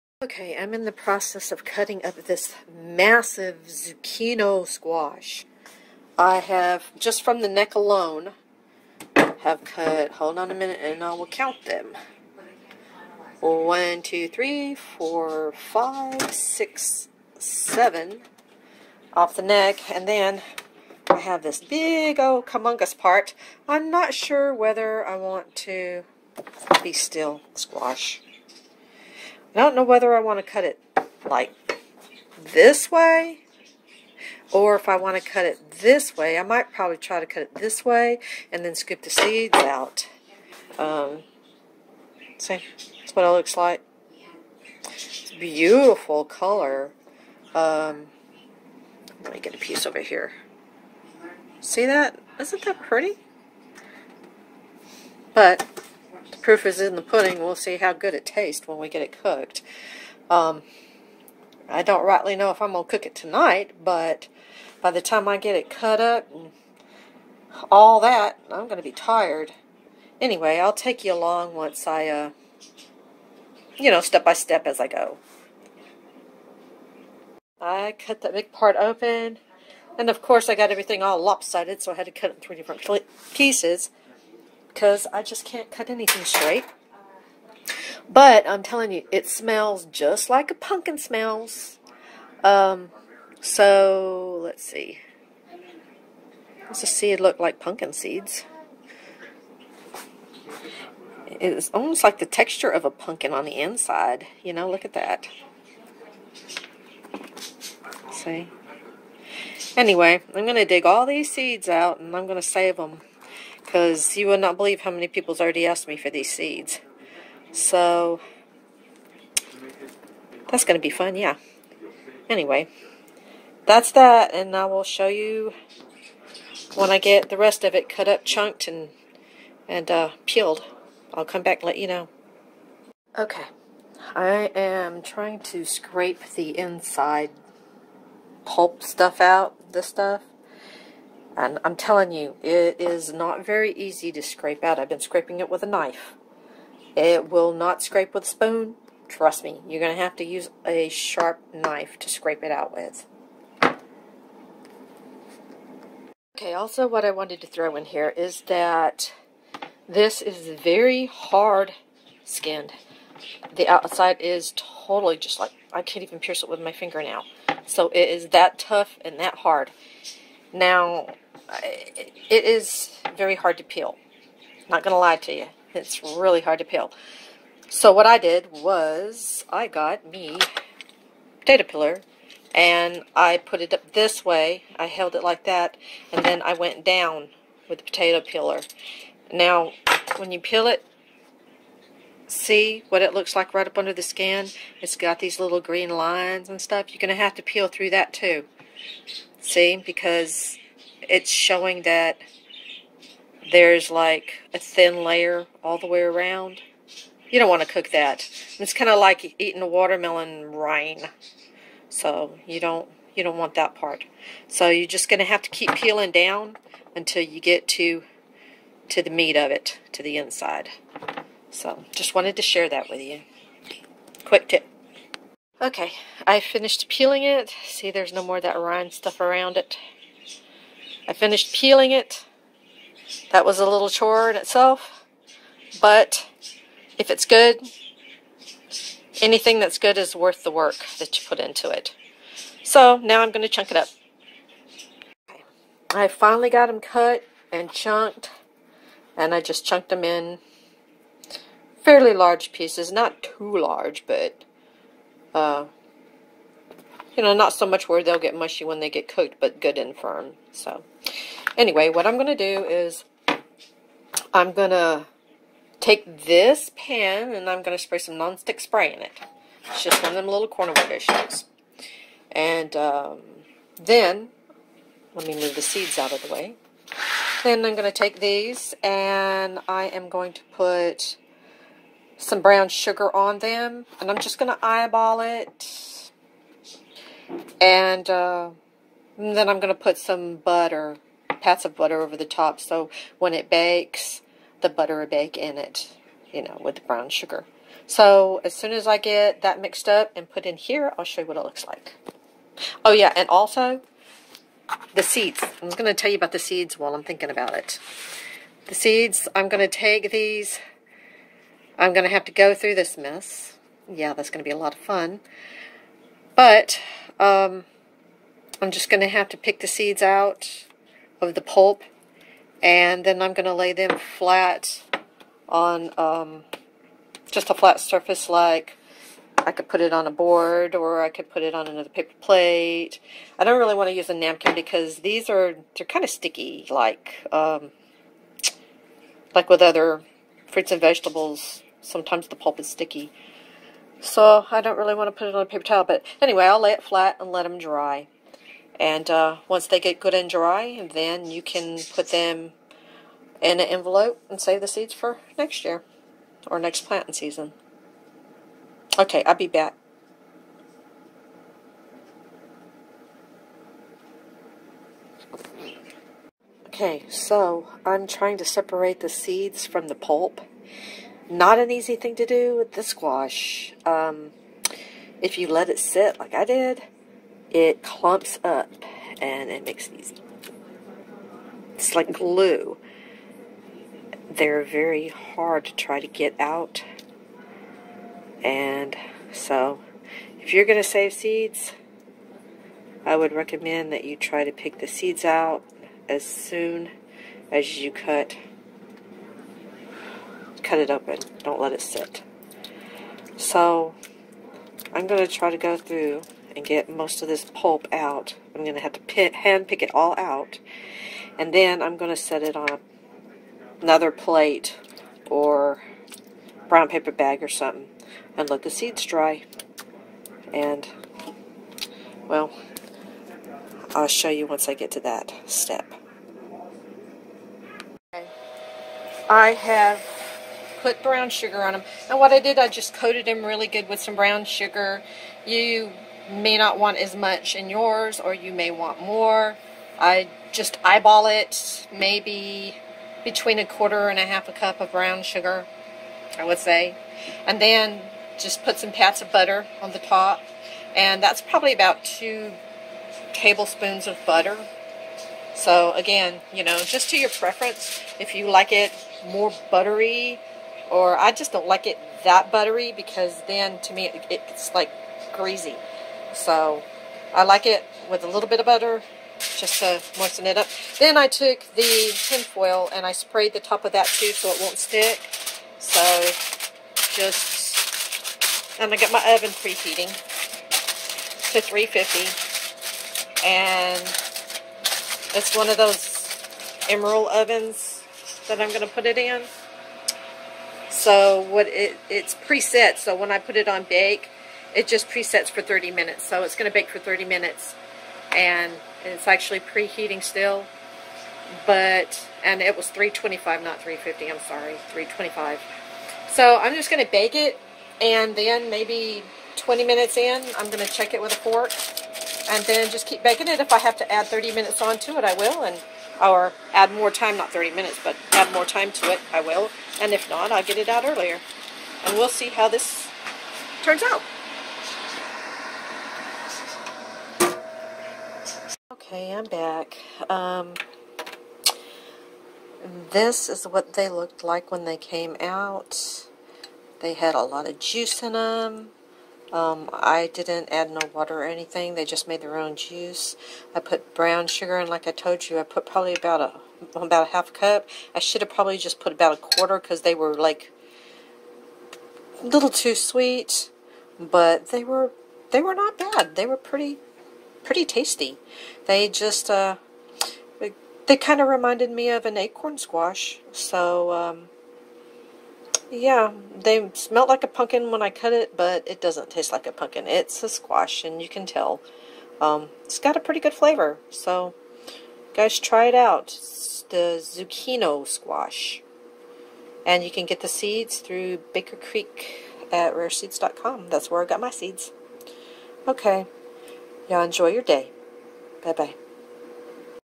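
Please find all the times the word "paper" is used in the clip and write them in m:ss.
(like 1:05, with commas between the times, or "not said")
5:31, 5:45, 6:56.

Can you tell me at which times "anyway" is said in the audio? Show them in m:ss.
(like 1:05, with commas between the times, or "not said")
1:10, 1:49, 2:02, 4:21, 5:46.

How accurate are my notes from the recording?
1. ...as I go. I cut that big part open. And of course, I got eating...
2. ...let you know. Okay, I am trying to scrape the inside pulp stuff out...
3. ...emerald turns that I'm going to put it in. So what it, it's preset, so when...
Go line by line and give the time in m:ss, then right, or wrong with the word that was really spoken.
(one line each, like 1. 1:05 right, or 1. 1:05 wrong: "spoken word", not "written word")
1. 1:14 wrong: "everything", not "eating"
2. 2:11 right
3. 8:06 wrong: "ovens", not "turns".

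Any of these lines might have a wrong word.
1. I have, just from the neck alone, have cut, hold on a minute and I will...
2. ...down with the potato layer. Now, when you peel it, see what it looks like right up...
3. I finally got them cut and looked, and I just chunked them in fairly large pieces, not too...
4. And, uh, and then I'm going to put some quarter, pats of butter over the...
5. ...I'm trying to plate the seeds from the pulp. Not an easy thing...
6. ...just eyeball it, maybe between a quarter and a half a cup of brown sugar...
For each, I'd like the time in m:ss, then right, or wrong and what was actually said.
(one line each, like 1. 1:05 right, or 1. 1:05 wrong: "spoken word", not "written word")
1. 0:06 right
2. 3:06 wrong: "peeler", not "layer"
3. 4:05 wrong: "chunked", not "looked"
4. 4:47 wrong: "butter", not "quarter"
5. 6:07 wrong: "separate", not "plate"
6. 7:20 right.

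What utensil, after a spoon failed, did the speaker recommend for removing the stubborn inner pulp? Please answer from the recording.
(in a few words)
sharp knife.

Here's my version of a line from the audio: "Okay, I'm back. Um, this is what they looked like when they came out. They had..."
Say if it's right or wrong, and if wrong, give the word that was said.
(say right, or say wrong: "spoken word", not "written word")
right.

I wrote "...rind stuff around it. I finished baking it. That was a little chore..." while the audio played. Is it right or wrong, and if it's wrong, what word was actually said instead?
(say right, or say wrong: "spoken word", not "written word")
wrong: "peeling", not "baking".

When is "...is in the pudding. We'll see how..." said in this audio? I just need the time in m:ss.
0:56.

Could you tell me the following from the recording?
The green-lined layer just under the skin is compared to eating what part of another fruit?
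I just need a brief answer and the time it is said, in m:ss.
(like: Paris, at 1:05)
watermelon rind, at 3:29.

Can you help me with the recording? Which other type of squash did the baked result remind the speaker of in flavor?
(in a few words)
acorn squash.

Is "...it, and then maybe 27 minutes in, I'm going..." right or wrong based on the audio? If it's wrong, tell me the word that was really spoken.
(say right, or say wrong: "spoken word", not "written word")
wrong: "20", not "27".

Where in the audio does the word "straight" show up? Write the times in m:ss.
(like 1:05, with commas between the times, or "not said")
1:26.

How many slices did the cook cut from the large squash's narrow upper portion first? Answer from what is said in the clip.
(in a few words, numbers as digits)
7.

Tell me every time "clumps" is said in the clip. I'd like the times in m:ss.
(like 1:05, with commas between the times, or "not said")
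6:17.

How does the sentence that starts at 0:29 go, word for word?
I don't know whether I want to cut it like this way or if I want to cut it this way.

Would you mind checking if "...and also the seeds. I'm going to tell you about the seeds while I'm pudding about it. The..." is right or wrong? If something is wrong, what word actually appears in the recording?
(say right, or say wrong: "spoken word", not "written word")
wrong: "thinking", not "pudding".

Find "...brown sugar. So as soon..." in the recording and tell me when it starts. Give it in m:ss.
4:56.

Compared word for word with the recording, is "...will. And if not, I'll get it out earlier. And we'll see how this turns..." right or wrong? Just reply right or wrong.
right.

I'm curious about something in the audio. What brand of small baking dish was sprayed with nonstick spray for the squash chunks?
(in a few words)
CorningWare.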